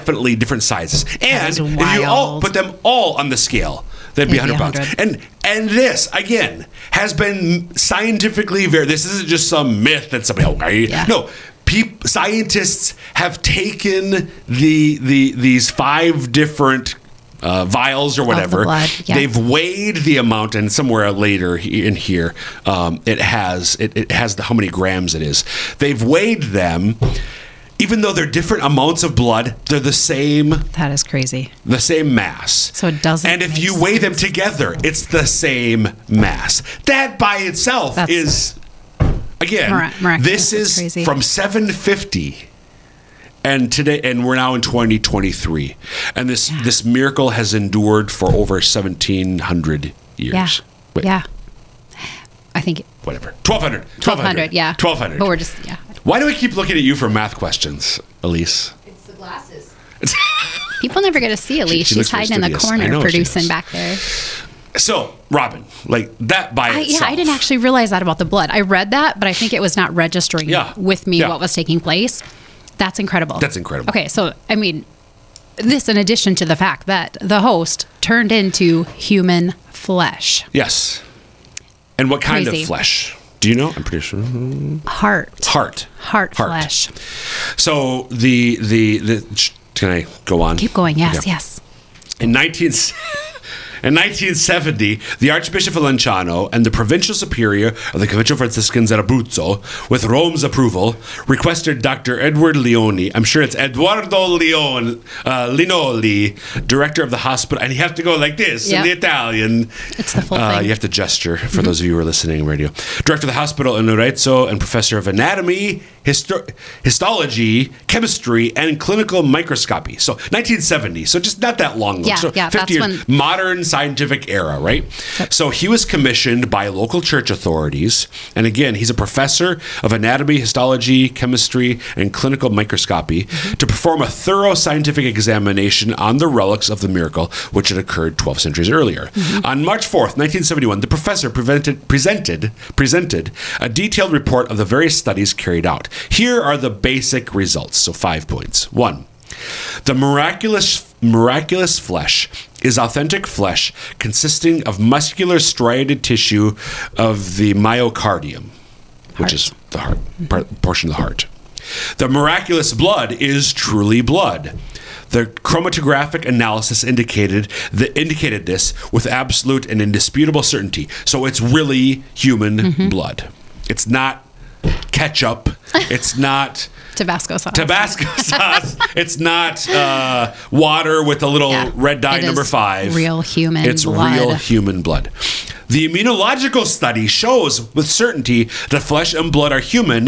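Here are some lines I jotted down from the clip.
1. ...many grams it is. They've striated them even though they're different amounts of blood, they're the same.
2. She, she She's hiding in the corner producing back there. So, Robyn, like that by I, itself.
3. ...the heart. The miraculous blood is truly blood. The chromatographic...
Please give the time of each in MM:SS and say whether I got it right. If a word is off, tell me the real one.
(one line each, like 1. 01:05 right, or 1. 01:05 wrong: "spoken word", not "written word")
1. 00:24 wrong: "weighed", not "striated"
2. 01:01 right
3. 02:40 right.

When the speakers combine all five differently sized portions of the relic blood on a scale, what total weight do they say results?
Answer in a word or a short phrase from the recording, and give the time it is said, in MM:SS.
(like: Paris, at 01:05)
100 pounds, at 00:04.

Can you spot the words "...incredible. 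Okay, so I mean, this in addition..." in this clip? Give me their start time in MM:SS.
01:13.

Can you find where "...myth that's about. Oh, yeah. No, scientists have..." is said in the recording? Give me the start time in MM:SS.
00:09.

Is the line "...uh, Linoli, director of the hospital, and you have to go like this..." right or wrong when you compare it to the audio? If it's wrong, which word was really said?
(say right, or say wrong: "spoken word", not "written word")
right.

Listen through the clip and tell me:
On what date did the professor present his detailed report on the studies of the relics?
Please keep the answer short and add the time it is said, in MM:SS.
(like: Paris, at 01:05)
March 4th, 1971, at 02:19.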